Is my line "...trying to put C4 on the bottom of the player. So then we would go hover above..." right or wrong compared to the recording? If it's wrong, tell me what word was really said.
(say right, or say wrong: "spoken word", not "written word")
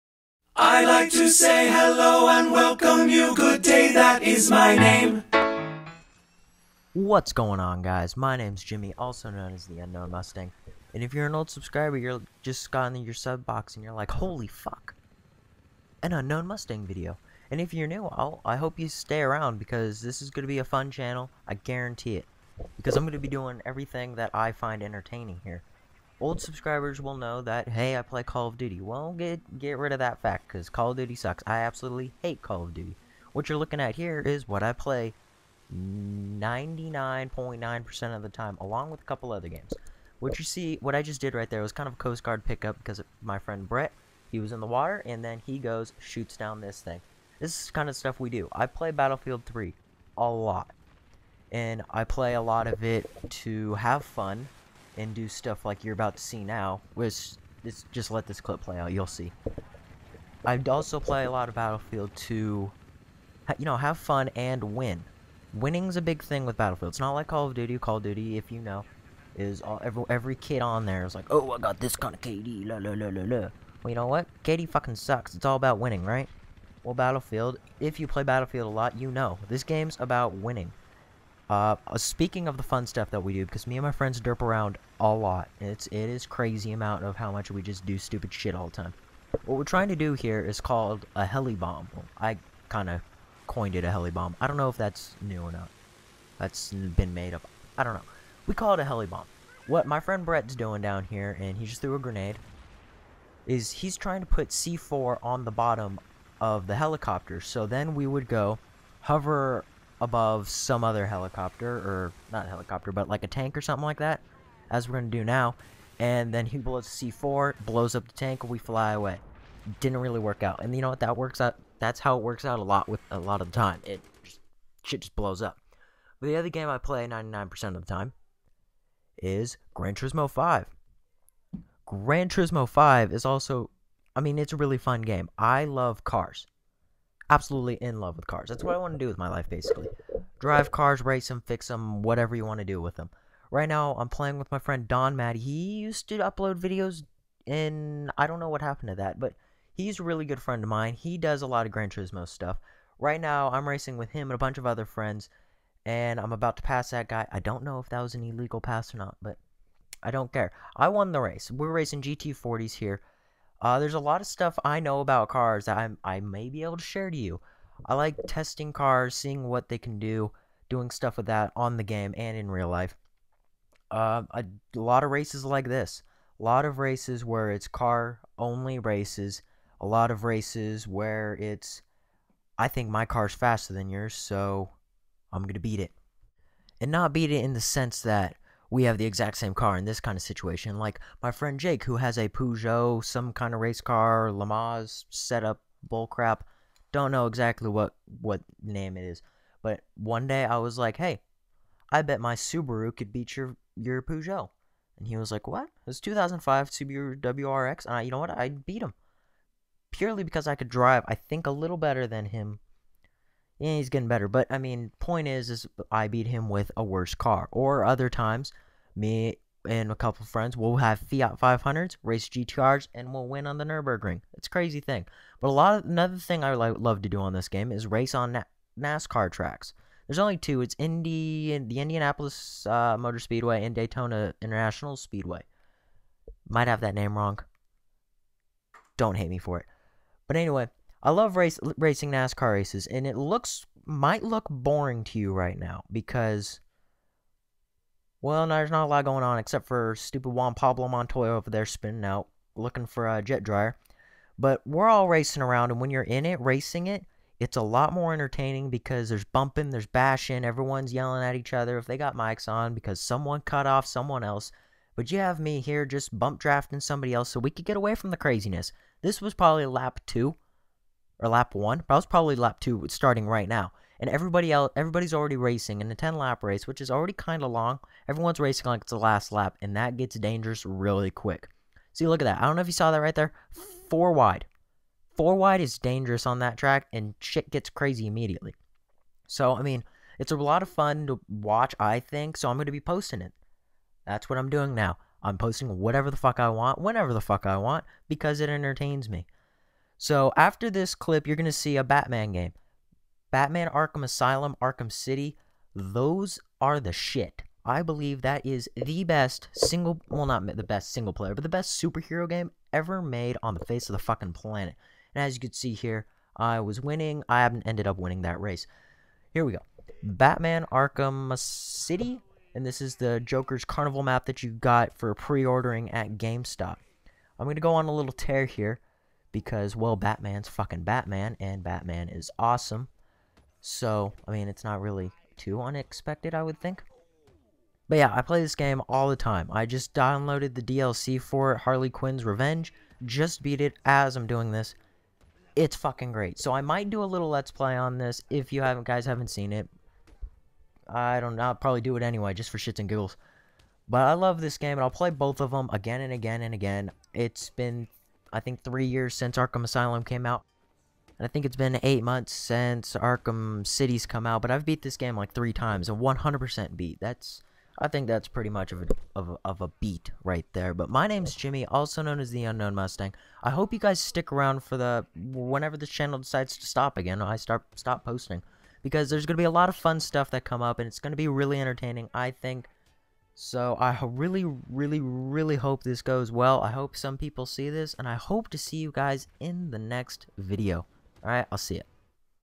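wrong: "helicopter", not "player".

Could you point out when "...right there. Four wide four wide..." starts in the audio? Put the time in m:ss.
4:43.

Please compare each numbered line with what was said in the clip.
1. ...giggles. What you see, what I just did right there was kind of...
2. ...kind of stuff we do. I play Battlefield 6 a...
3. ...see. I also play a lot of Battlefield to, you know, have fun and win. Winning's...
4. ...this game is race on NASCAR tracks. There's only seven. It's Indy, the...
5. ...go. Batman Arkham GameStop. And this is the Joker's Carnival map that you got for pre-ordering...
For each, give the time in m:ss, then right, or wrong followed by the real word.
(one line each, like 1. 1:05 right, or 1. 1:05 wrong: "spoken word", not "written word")
1. 0:39 wrong: "games", not "giggles"
2. 0:47 wrong: "3", not "6"
3. 0:59 right
4. 3:47 wrong: "two", not "seven"
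5. 5:19 wrong: "City", not "GameStop".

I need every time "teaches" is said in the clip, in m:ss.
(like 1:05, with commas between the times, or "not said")
not said.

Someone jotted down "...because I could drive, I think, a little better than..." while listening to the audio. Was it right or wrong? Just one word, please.
right.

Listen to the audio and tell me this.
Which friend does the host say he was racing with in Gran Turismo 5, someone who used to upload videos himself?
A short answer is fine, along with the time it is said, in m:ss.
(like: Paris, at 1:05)
Don Mad, at 2:24.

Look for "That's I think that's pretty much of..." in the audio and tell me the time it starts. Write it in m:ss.
6:07.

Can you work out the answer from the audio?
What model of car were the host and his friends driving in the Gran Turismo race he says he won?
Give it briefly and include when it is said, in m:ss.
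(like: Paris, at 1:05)
GT40s, at 2:42.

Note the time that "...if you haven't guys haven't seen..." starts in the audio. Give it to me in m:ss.
5:48.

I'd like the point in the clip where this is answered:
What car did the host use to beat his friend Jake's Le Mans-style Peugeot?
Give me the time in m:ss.
3:25.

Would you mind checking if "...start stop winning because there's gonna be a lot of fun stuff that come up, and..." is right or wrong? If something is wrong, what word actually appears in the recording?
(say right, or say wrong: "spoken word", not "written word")
wrong: "posting", not "winning".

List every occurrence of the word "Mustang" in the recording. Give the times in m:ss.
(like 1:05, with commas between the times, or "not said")
0:10, 0:16, 6:12.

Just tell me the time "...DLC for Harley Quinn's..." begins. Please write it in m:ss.
5:40.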